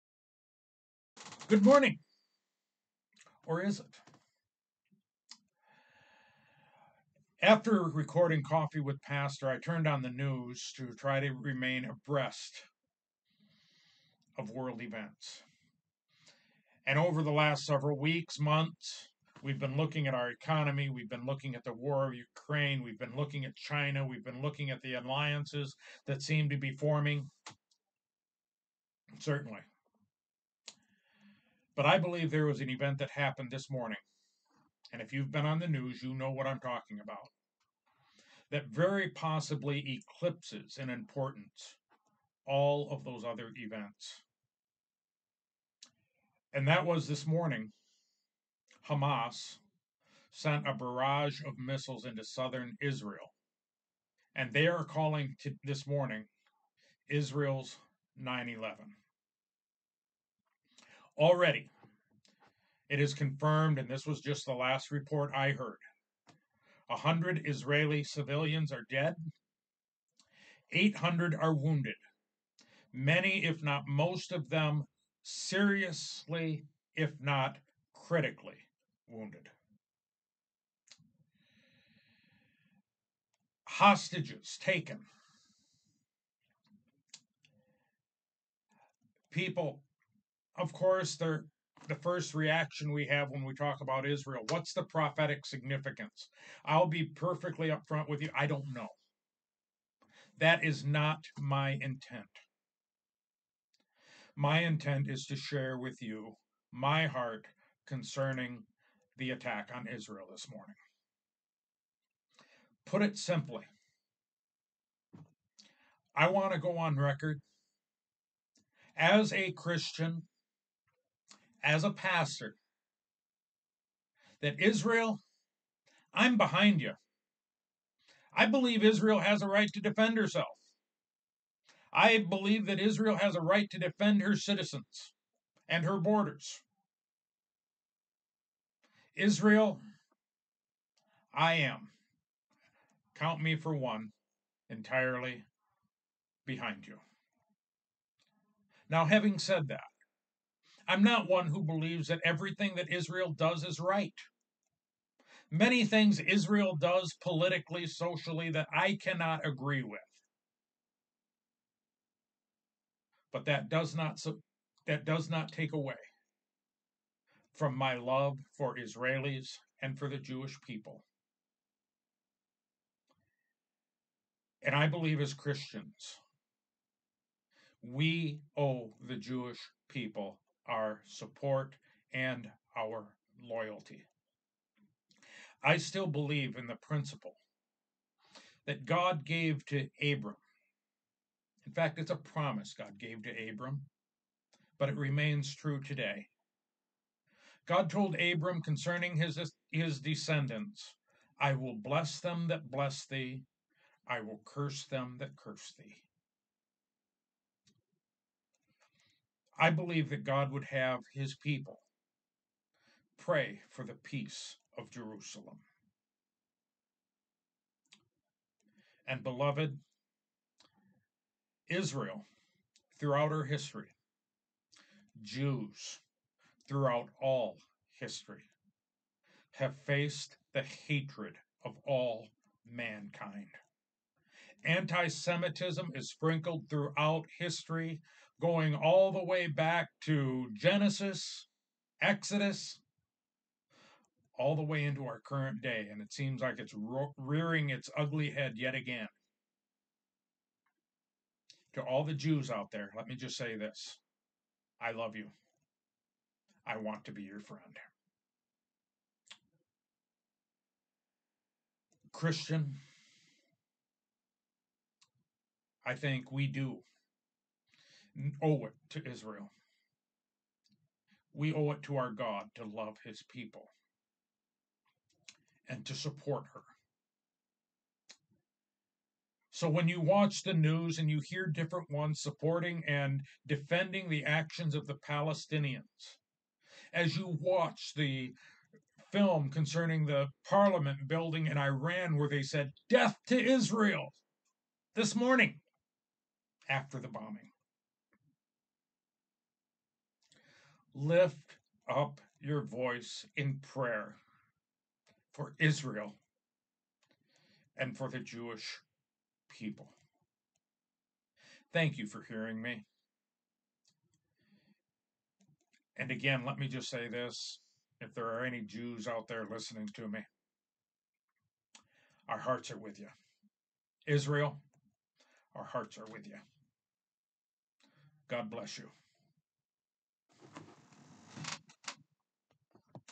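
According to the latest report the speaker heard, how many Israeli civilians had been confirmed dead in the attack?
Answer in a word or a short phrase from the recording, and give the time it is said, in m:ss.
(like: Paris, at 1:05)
100, at 1:06.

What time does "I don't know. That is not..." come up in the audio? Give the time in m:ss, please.
1:38.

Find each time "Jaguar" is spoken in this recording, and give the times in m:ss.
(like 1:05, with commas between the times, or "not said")
not said.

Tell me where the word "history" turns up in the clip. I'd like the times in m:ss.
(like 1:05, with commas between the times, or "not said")
3:43, 3:47, 3:57.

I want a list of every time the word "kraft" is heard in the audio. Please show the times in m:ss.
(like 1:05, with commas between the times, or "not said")
not said.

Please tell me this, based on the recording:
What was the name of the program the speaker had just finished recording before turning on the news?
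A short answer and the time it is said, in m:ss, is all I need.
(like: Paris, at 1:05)
Coffee with Pastor, at 0:08.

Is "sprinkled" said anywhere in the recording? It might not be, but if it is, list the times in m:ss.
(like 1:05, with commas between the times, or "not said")
3:56.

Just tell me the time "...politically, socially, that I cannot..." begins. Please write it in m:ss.
2:37.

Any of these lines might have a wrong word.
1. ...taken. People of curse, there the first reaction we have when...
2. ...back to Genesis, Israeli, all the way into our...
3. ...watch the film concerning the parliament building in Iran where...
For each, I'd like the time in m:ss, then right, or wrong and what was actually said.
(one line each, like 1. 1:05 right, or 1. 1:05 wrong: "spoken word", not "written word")
1. 1:24 wrong: "course", not "curse"
2. 3:59 wrong: "Exodus", not "Israeli"
3. 4:47 right.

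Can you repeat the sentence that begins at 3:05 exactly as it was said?
I still believe in the principle that God gave to Abram.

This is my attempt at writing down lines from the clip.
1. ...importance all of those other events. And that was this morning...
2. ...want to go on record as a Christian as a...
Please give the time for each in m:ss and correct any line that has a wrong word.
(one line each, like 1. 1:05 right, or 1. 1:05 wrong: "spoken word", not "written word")
1. 0:40 right
2. 1:56 right.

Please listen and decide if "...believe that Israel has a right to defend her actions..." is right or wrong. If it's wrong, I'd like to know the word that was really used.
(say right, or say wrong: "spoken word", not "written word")
wrong: "citizens", not "actions".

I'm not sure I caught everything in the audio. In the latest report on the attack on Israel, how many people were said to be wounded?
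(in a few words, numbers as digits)
800.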